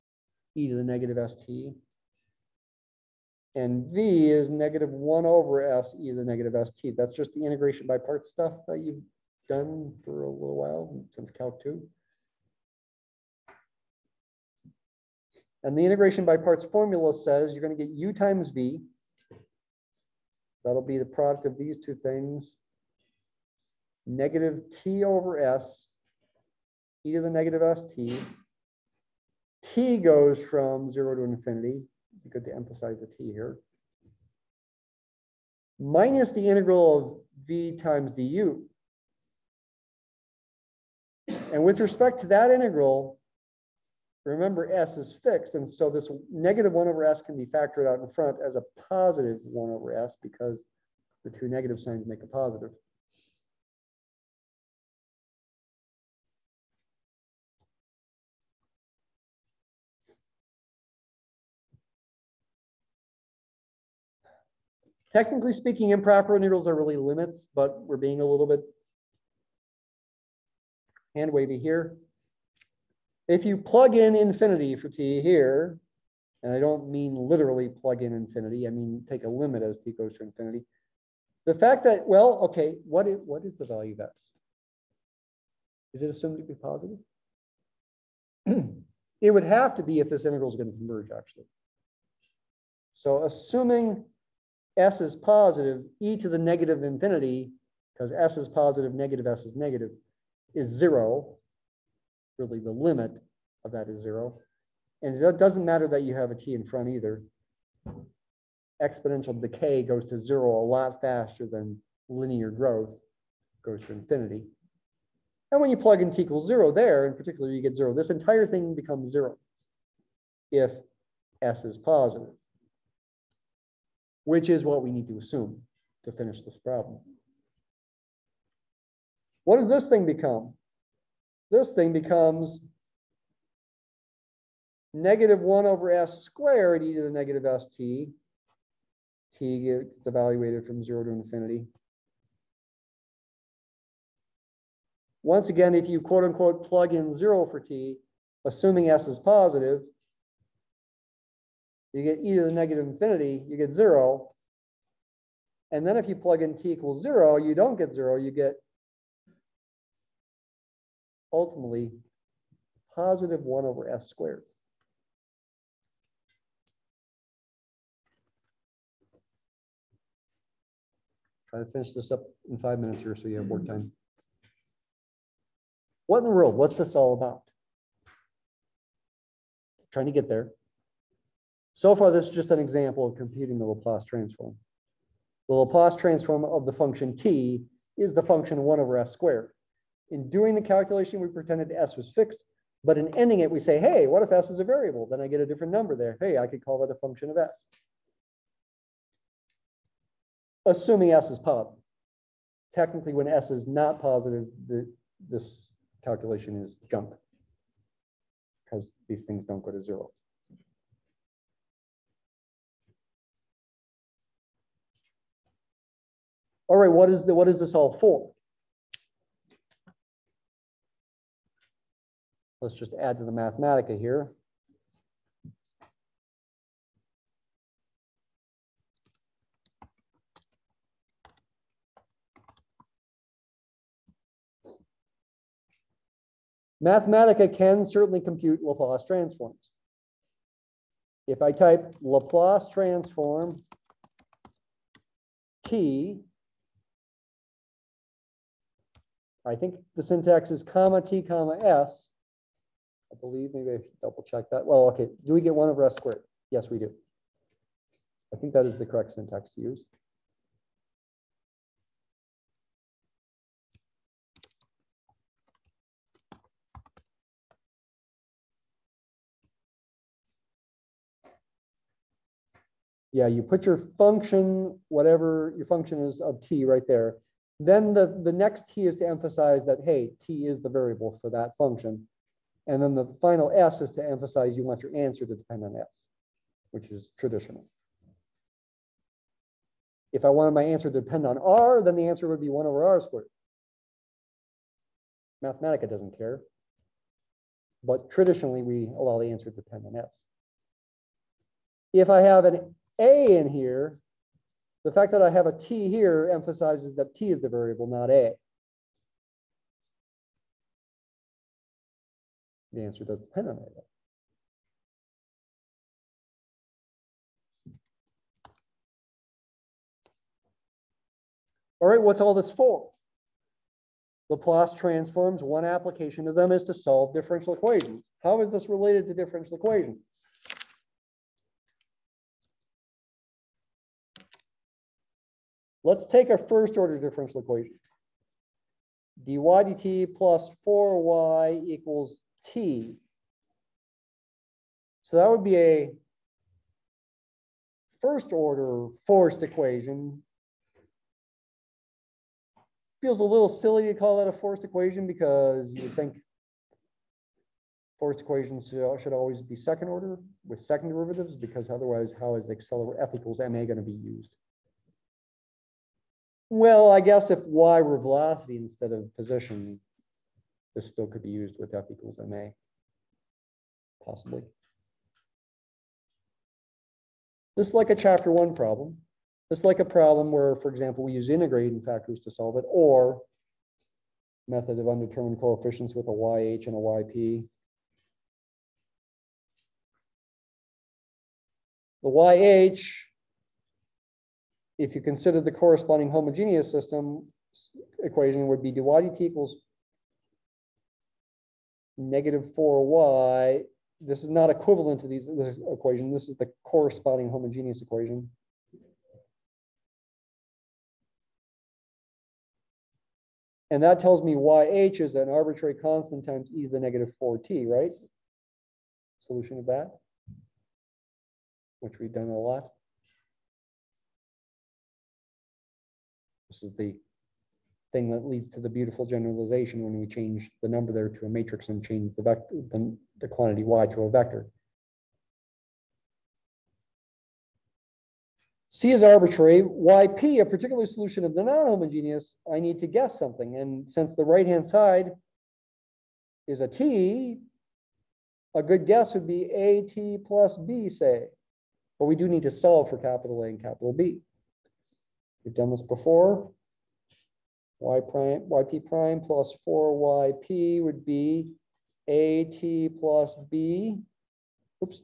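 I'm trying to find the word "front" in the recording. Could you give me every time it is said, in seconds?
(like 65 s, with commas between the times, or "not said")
48 s, 106 s.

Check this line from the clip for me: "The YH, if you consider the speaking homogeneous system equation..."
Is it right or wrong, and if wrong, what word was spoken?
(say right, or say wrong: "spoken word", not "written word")
wrong: "corresponding", not "speaking".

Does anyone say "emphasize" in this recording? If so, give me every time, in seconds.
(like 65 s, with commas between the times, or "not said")
32 s, 279 s, 284 s, 306 s.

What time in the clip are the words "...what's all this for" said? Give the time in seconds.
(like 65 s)
322 s.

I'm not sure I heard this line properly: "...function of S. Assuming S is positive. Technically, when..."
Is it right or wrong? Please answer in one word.
right.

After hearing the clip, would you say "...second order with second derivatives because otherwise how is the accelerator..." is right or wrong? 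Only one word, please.
right.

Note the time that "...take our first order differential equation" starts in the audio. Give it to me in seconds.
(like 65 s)
336 s.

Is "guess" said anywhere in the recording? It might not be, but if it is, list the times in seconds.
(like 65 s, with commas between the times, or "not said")
366 s, 442 s, 448 s.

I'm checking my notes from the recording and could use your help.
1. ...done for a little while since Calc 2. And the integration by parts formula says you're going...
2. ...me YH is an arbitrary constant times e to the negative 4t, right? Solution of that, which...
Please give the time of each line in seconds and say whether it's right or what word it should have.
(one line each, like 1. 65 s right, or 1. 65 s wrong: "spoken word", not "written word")
1. 9 s right
2. 414 s right.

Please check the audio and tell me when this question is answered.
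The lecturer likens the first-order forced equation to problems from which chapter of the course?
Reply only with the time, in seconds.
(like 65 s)
377 s.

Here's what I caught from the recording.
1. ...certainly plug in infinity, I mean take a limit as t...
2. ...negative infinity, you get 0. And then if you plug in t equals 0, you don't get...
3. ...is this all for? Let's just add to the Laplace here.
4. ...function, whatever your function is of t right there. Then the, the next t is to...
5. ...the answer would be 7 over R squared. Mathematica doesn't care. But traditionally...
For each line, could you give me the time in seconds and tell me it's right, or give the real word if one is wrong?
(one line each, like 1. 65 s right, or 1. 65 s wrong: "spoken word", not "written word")
1. 77 s wrong: "literally", not "certainly"
2. 152 s right
3. 217 s wrong: "Mathematica", not "Laplace"
4. 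273 s right
5. 291 s wrong: "1", not "7".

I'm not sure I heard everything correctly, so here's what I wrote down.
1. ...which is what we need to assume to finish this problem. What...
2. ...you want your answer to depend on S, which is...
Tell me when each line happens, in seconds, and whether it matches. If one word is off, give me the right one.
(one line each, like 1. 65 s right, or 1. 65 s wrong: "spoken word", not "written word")
1. 124 s right
2. 284 s right.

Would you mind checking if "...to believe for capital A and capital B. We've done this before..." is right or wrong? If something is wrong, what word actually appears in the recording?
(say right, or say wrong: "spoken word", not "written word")
wrong: "solve", not "believe".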